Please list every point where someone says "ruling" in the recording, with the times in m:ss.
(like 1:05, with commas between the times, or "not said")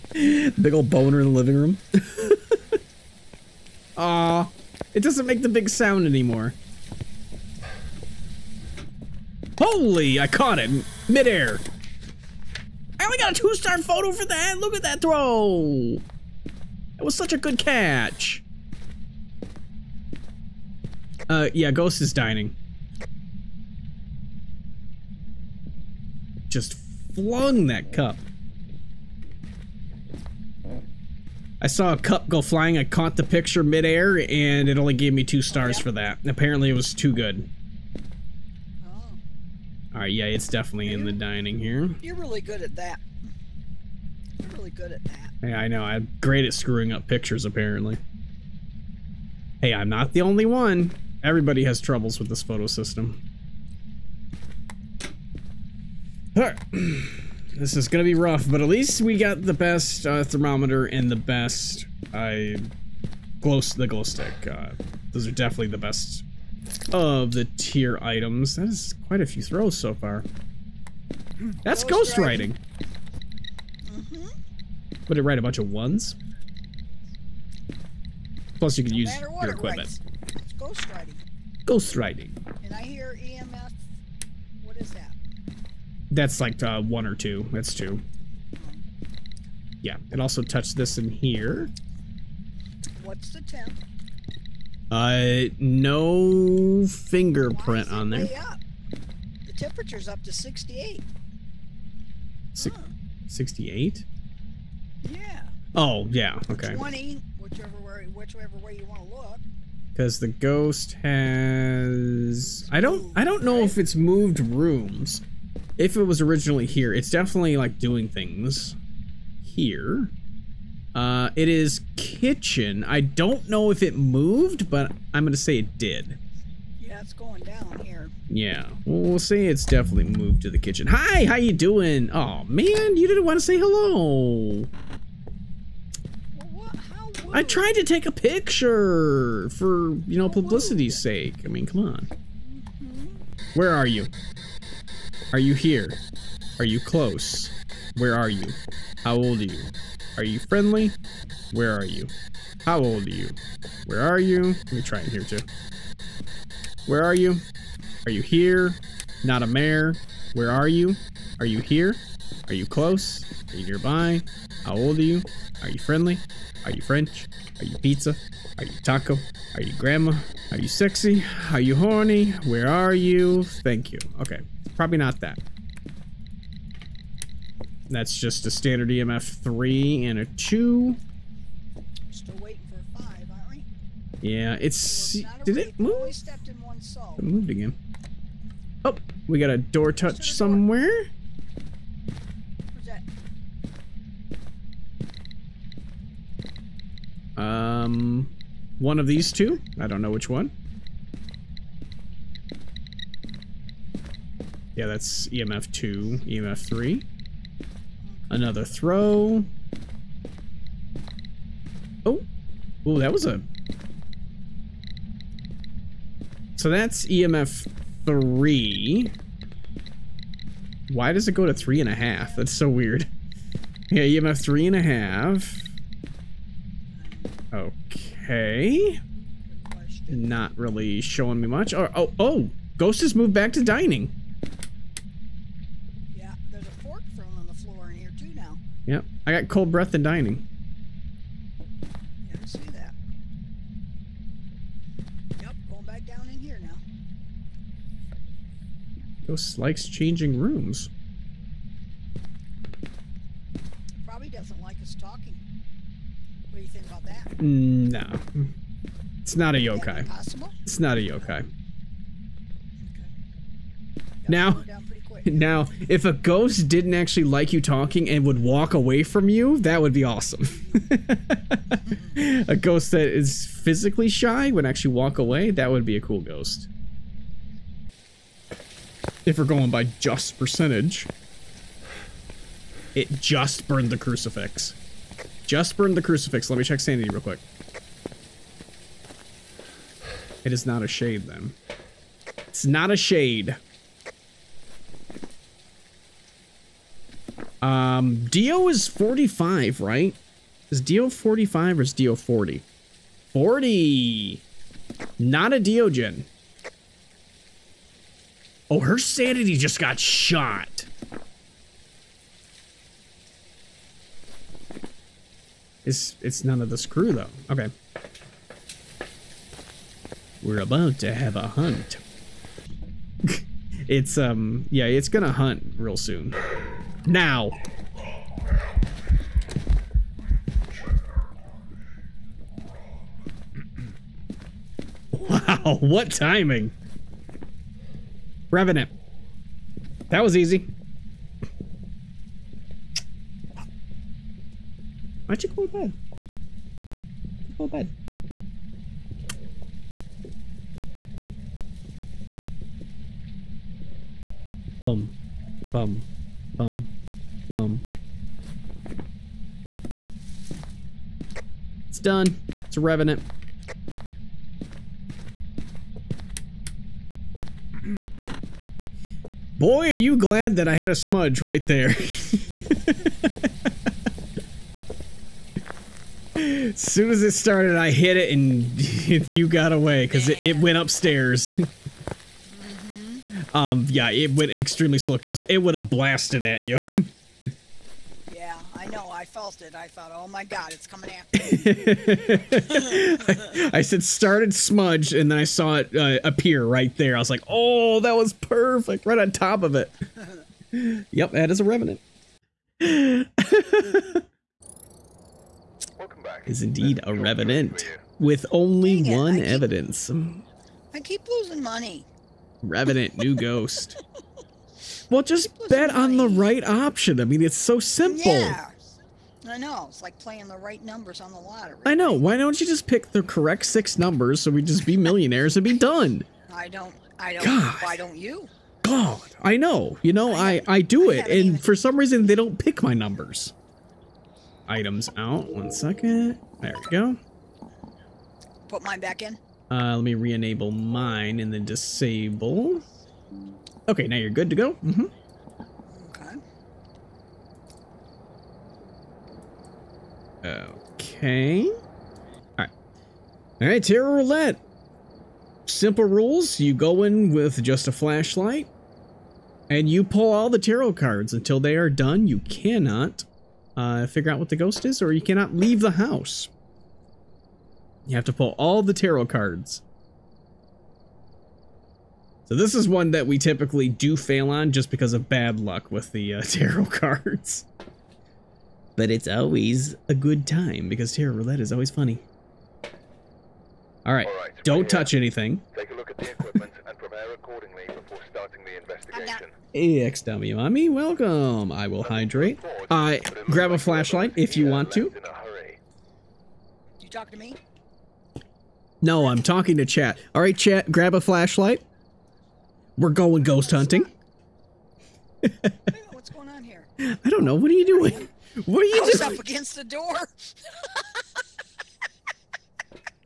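not said.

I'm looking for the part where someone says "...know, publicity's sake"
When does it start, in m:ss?
2:20.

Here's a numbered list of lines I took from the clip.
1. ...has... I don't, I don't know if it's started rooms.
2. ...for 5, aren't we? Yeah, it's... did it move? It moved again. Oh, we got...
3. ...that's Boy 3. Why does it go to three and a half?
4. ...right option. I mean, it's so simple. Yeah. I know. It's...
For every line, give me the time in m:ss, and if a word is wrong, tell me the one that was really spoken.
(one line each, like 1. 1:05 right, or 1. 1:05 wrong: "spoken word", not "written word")
1. 1:51 wrong: "moved", not "started"
2. 3:02 right
3. 3:36 wrong: "EMF", not "Boy"
4. 6:56 right.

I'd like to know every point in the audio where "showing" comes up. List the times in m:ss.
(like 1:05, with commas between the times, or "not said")
3:50.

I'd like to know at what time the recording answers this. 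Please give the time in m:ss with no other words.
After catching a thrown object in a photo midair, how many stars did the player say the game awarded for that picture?
0:13.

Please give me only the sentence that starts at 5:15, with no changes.
It's, it's none of the screw though.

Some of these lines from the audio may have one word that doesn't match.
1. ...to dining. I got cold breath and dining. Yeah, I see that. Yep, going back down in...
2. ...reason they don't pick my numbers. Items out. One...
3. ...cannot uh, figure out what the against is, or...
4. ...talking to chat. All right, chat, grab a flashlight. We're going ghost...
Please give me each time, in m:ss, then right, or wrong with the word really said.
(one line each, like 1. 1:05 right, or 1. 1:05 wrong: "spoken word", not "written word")
1. 3:53 right
2. 7:11 right
3. 7:42 wrong: "ghost", not "against"
4. 8:19 right.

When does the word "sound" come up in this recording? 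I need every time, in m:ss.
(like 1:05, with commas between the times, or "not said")
0:05.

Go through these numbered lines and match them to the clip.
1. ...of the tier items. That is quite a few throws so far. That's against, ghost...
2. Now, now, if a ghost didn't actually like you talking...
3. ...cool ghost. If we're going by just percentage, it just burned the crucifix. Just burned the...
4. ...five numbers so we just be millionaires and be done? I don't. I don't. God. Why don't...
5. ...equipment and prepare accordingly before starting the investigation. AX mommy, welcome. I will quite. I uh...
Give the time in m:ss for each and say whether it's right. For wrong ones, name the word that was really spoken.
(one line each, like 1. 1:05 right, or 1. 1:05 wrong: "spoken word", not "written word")
1. 1:06 wrong: "ghost", not "against"
2. 4:24 right
3. 4:36 right
4. 7:03 wrong: "six", not "five"
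5. 8:06 wrong: "hydrate", not "quite".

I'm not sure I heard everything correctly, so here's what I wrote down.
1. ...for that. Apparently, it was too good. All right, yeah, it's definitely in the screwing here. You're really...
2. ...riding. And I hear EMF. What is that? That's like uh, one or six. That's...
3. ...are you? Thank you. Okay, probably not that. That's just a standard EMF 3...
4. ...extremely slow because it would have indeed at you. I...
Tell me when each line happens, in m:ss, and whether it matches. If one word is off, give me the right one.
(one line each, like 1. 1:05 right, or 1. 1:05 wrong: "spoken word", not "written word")
1. 0:35 wrong: "dining", not "screwing"
2. 1:21 wrong: "two", not "six"
3. 2:52 right
4. 6:24 wrong: "blasted", not "indeed".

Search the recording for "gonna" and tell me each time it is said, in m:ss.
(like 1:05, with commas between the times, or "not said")
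0:57, 5:25.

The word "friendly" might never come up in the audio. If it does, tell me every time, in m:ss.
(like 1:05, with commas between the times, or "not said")
2:30, 2:45.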